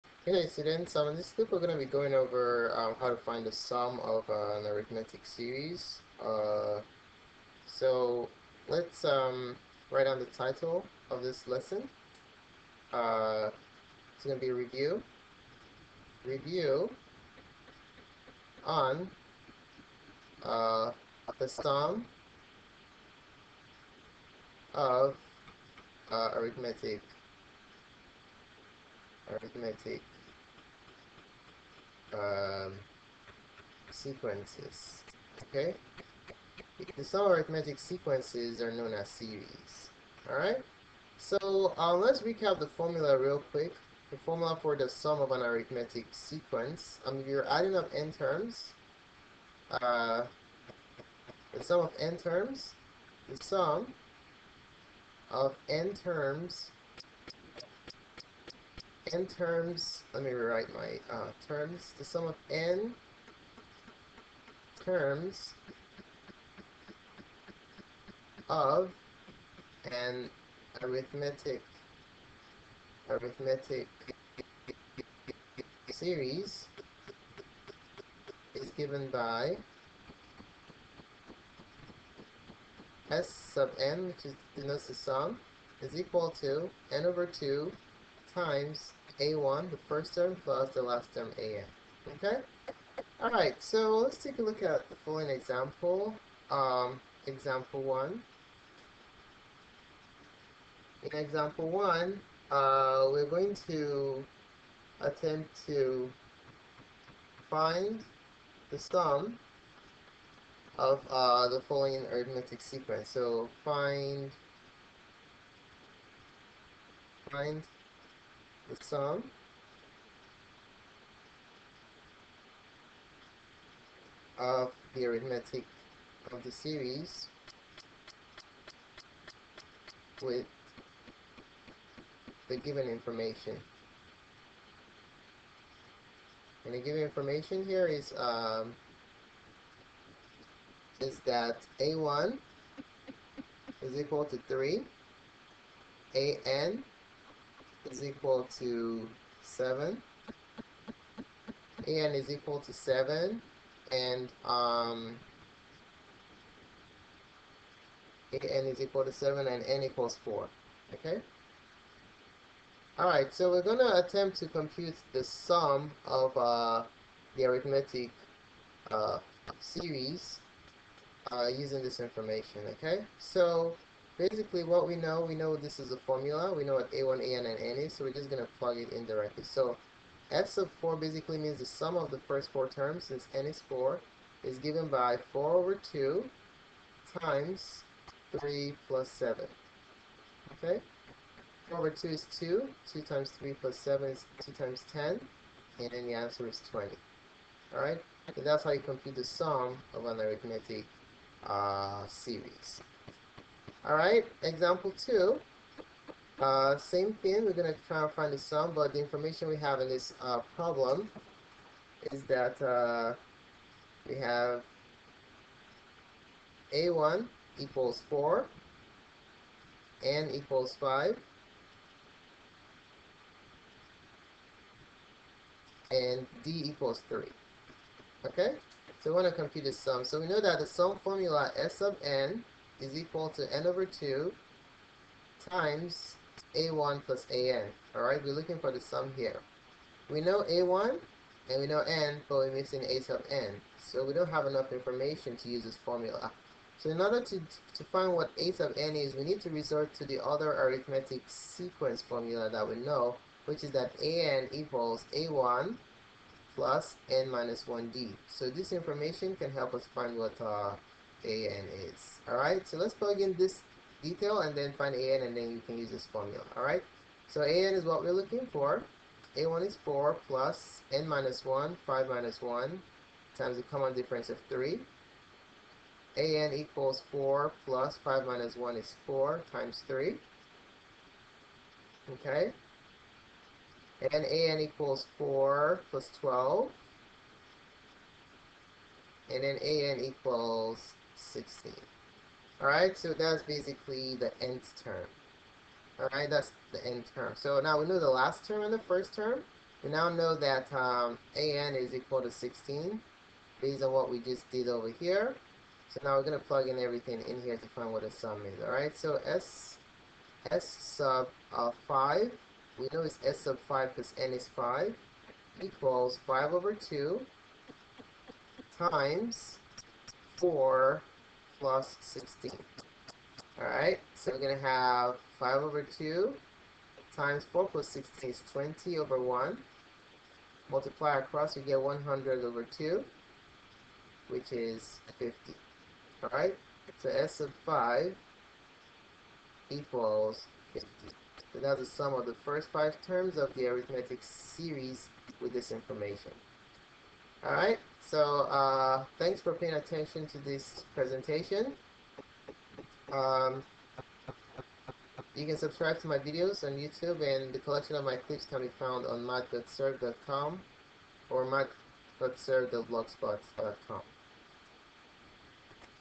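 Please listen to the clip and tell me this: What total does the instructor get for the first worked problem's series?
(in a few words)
20.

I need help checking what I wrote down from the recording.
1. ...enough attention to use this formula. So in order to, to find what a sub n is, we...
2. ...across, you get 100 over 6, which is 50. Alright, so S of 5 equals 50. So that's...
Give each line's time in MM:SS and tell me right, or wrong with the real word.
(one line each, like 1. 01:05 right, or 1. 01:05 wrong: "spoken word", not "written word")
1. 04:04 wrong: "information", not "attention"
2. 05:31 wrong: "2", not "6".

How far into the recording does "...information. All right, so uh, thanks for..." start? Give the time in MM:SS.
05:45.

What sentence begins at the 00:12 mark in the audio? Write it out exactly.
Uh, it's going to be review.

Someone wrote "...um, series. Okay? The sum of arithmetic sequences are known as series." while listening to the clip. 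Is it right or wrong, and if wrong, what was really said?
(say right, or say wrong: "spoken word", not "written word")
wrong: "sequences", not "series".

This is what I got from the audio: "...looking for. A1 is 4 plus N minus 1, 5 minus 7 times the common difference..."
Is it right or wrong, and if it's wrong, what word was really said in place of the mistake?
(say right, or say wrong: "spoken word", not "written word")
wrong: "1", not "7".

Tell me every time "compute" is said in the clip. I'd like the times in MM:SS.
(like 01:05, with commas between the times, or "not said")
02:44, 03:18, 03:49.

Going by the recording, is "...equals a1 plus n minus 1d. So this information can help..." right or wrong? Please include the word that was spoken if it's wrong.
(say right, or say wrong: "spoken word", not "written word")
right.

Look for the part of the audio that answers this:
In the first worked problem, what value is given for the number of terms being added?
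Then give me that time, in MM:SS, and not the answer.
02:39.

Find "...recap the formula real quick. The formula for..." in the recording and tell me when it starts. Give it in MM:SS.
00:42.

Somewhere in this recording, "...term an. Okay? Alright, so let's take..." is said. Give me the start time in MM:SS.
01:31.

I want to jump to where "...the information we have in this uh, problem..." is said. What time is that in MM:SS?
03:28.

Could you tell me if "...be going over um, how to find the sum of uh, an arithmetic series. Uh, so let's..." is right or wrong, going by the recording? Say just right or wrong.
right.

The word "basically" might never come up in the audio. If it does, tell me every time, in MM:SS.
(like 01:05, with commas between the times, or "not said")
02:54, 03:00, 04:53.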